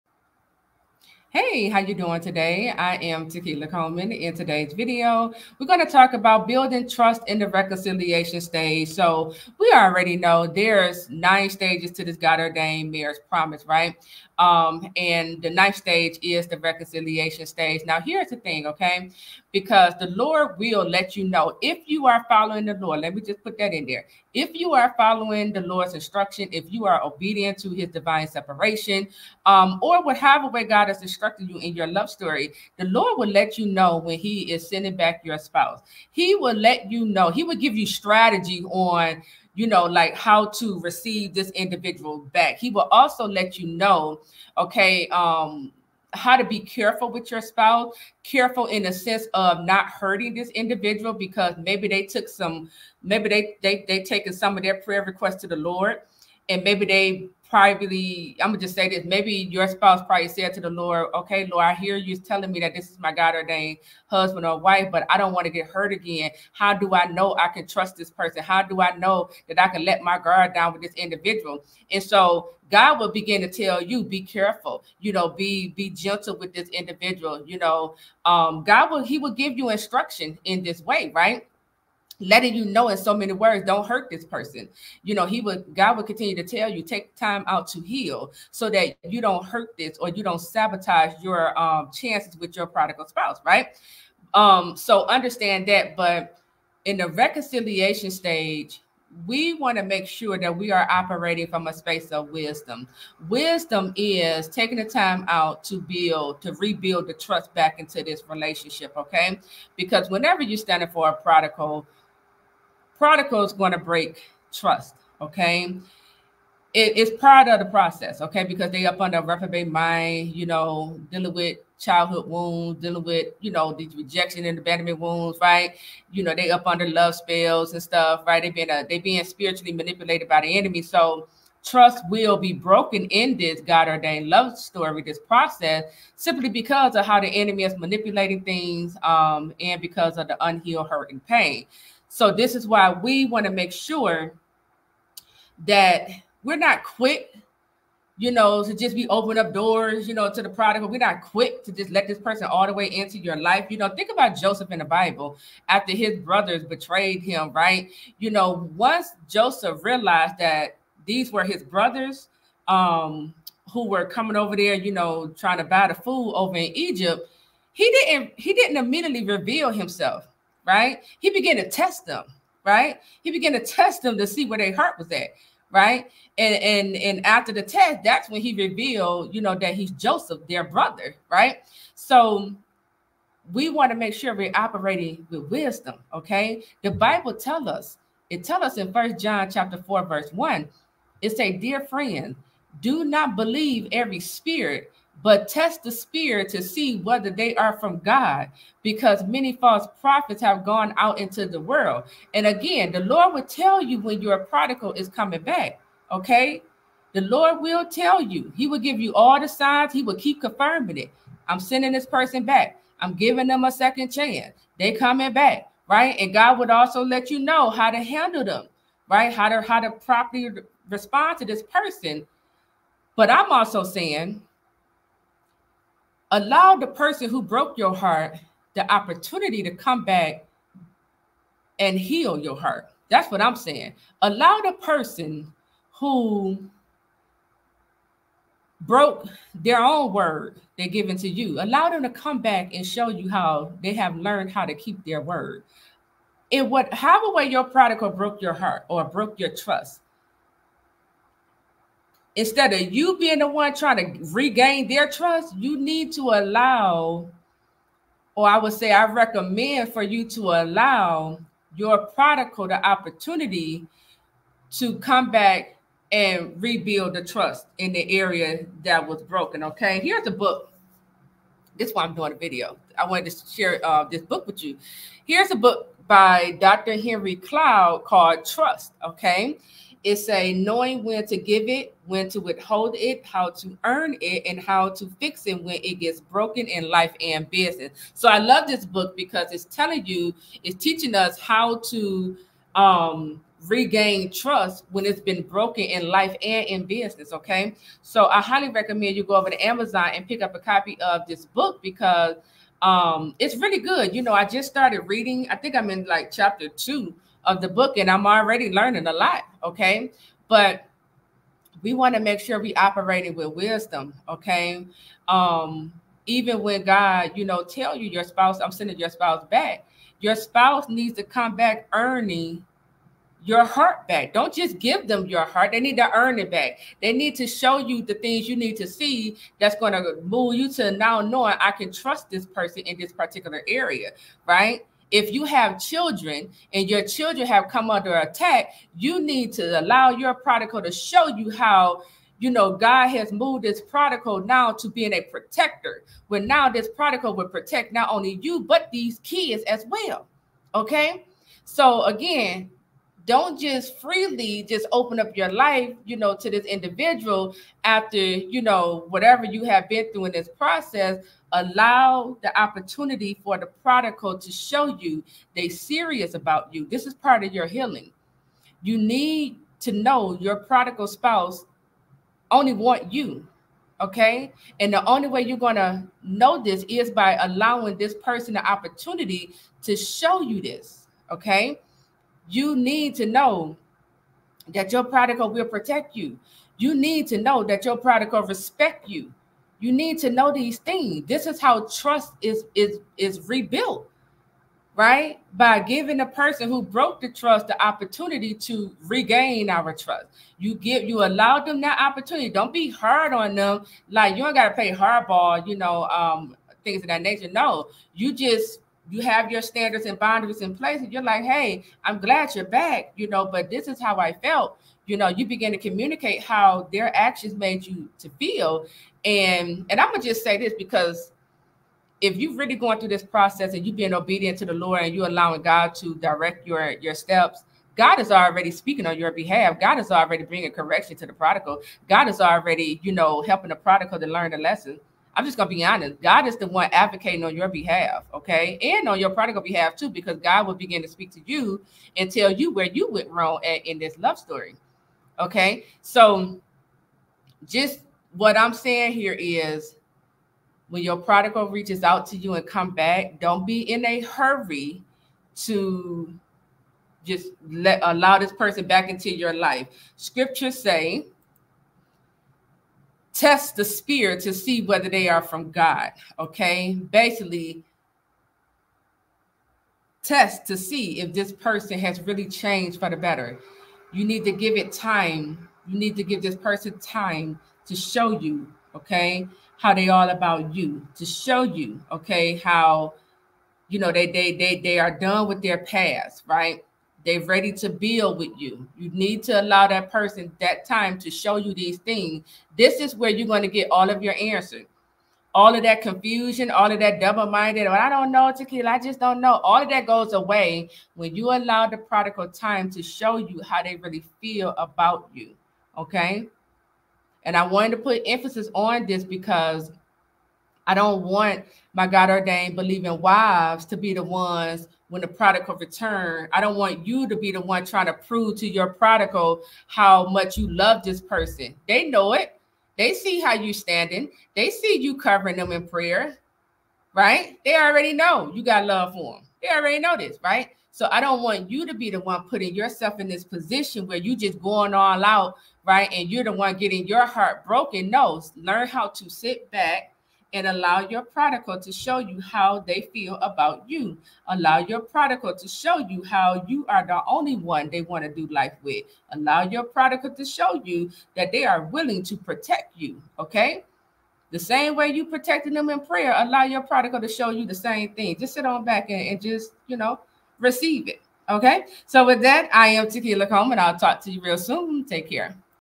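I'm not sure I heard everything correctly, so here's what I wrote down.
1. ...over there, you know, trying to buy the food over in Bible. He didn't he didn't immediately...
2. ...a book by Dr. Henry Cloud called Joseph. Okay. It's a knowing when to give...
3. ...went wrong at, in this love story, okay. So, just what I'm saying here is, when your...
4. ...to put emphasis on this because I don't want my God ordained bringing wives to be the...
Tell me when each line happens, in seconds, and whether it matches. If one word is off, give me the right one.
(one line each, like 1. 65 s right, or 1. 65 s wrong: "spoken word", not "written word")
1. 164 s wrong: "Egypt", not "Bible"
2. 275 s wrong: "Trust", not "Joseph"
3. 443 s right
4. 507 s wrong: "believing", not "bringing".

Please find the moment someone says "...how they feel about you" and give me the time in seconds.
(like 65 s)
542 s.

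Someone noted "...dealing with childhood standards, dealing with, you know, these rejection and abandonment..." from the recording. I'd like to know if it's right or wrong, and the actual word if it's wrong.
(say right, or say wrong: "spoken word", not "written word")
wrong: "wounds", not "standards".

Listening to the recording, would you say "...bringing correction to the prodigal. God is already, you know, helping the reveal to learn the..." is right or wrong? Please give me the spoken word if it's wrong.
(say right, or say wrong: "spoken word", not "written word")
wrong: "prodigal", not "reveal".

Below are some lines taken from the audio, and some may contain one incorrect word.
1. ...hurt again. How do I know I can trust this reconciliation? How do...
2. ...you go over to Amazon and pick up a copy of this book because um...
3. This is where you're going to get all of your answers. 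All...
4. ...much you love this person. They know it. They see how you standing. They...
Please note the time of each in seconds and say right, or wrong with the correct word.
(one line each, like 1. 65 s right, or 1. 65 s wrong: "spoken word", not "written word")
1. 65 s wrong: "person", not "reconciliation"
2. 299 s right
3. 492 s right
4. 520 s right.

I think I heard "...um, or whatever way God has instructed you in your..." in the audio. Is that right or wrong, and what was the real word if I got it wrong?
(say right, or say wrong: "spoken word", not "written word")
right.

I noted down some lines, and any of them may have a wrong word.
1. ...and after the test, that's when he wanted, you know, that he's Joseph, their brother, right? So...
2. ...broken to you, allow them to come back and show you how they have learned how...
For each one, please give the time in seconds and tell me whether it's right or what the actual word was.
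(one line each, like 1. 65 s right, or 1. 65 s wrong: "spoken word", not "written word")
1. 176 s wrong: "revealed", not "wanted"
2. 240 s wrong: "given", not "broken".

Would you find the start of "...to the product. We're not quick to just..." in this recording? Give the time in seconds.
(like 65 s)
150 s.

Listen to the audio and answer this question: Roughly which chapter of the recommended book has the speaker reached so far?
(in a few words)
Chapter 2.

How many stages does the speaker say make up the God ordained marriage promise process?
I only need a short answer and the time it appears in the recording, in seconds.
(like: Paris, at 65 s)
9, at 11 s.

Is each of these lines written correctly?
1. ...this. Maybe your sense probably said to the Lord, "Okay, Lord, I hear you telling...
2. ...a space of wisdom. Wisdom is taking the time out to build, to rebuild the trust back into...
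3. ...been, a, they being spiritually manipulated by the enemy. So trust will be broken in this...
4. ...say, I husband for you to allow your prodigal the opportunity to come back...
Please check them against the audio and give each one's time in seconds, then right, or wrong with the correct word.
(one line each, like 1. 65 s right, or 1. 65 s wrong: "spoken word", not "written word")
1. 58 s wrong: "spouse", not "sense"
2. 101 s right
3. 128 s right
4. 258 s wrong: "recommend", not "husband".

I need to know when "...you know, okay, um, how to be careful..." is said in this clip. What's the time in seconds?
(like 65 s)
43 s.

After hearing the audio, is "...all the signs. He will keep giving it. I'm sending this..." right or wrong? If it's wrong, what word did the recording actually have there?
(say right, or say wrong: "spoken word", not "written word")
wrong: "confirming", not "giving".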